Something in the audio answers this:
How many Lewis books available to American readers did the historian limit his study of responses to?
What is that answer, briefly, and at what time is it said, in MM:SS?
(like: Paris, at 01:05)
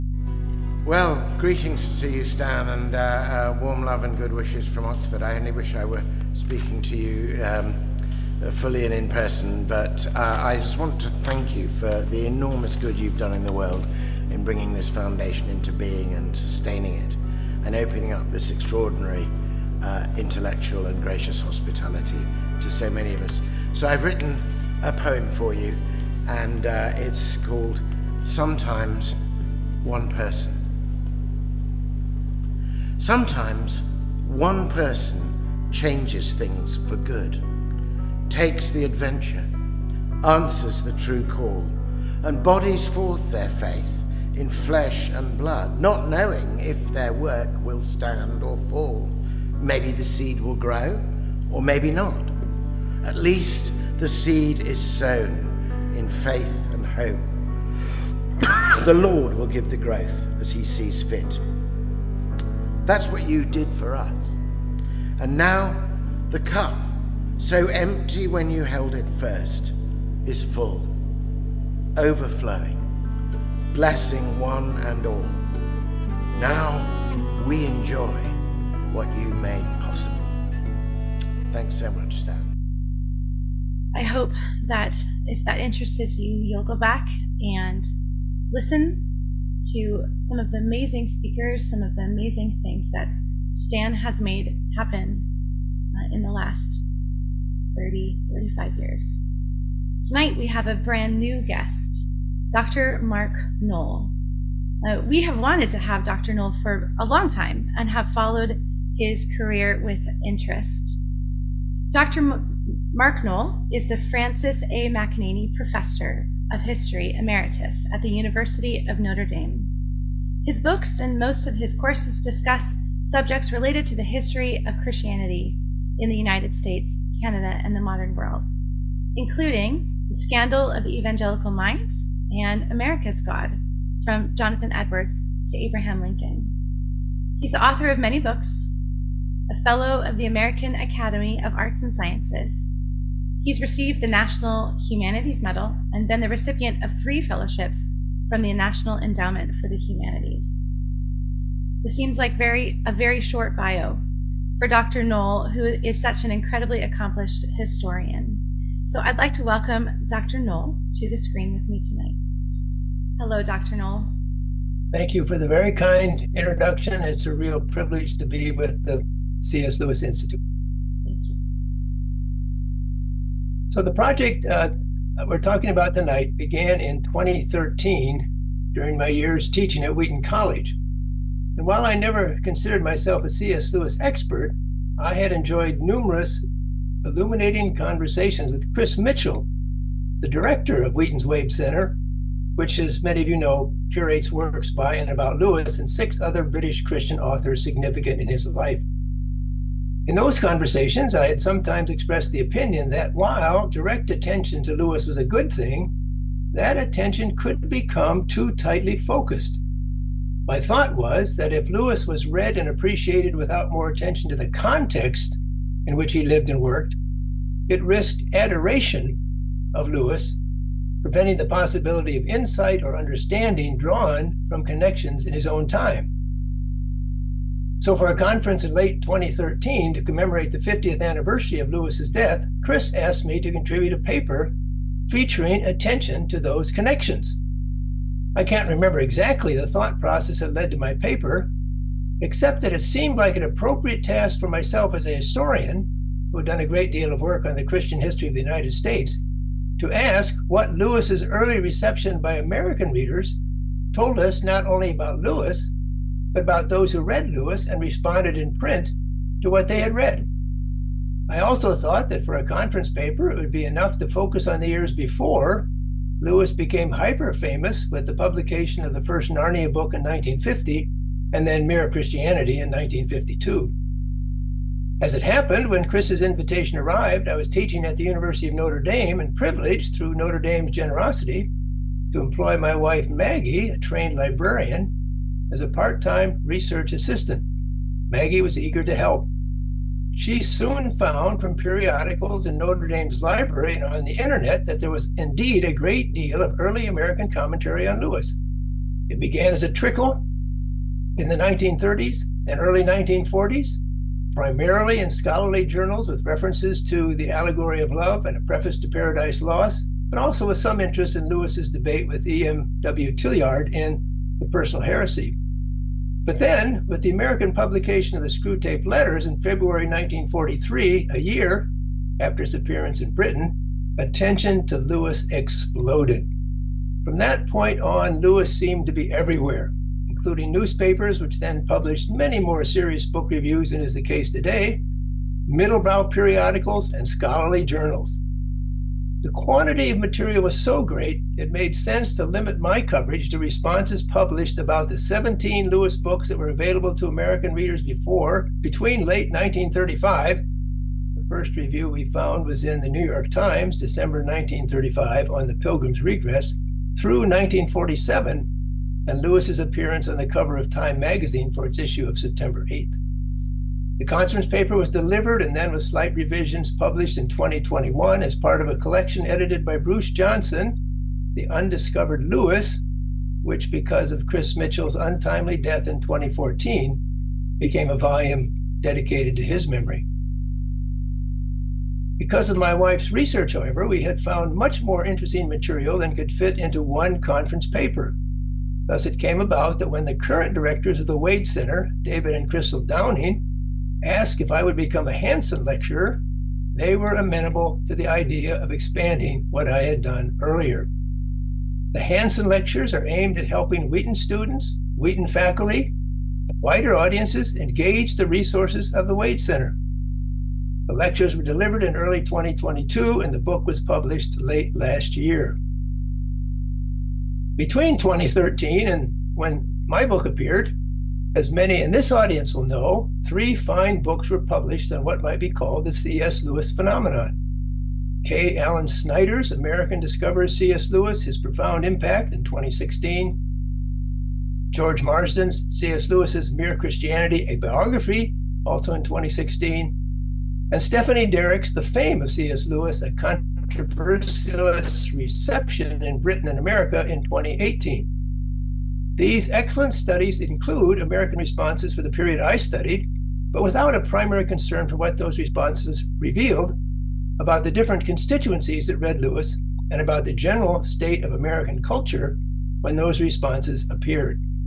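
17, at 05:44.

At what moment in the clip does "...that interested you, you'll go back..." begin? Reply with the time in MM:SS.
01:25.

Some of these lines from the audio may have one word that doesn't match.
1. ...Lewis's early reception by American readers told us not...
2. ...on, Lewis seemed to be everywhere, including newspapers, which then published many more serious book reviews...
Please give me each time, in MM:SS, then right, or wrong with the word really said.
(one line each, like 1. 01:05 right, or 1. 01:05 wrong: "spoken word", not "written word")
1. 04:10 right
2. 05:27 right.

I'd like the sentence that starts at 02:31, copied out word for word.
This seems like very a very short bio for Dr.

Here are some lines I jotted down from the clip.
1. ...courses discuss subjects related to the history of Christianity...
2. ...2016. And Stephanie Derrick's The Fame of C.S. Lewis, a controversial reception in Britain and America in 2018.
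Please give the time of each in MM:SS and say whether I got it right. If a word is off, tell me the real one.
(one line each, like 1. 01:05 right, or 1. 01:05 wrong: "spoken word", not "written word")
1. 02:01 right
2. 07:19 right.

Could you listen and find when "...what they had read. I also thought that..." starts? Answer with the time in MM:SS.
04:19.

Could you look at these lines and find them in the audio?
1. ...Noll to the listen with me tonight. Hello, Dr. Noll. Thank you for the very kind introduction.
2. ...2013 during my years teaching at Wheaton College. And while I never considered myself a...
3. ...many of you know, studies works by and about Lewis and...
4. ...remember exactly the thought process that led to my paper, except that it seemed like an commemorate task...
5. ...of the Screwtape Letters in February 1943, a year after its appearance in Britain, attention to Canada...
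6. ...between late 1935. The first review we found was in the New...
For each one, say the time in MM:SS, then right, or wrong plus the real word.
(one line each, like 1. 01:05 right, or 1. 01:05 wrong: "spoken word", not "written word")
1. 02:40 wrong: "screen", not "listen"
2. 02:57 right
3. 03:13 wrong: "curates", not "studies"
4. 03:58 wrong: "appropriate", not "commemorate"
5. 05:18 wrong: "Lewis", not "Canada"
6. 05:48 right.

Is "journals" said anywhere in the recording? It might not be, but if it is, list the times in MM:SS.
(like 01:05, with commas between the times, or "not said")
05:05, 05:37.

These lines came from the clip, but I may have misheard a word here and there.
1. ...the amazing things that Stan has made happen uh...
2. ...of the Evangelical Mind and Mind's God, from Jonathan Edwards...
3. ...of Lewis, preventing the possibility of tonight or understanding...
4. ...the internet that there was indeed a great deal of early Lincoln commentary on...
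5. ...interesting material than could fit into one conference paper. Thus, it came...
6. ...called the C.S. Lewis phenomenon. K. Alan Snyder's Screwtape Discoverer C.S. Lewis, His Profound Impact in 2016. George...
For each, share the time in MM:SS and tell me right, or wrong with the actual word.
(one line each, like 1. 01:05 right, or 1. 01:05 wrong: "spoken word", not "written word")
1. 01:31 right
2. 02:10 wrong: "America", not "Mind"
3. 03:39 wrong: "insight", not "tonight"
4. 04:54 wrong: "American", not "Lincoln"
5. 06:25 right
6. 07:05 wrong: "American", not "Screwtape".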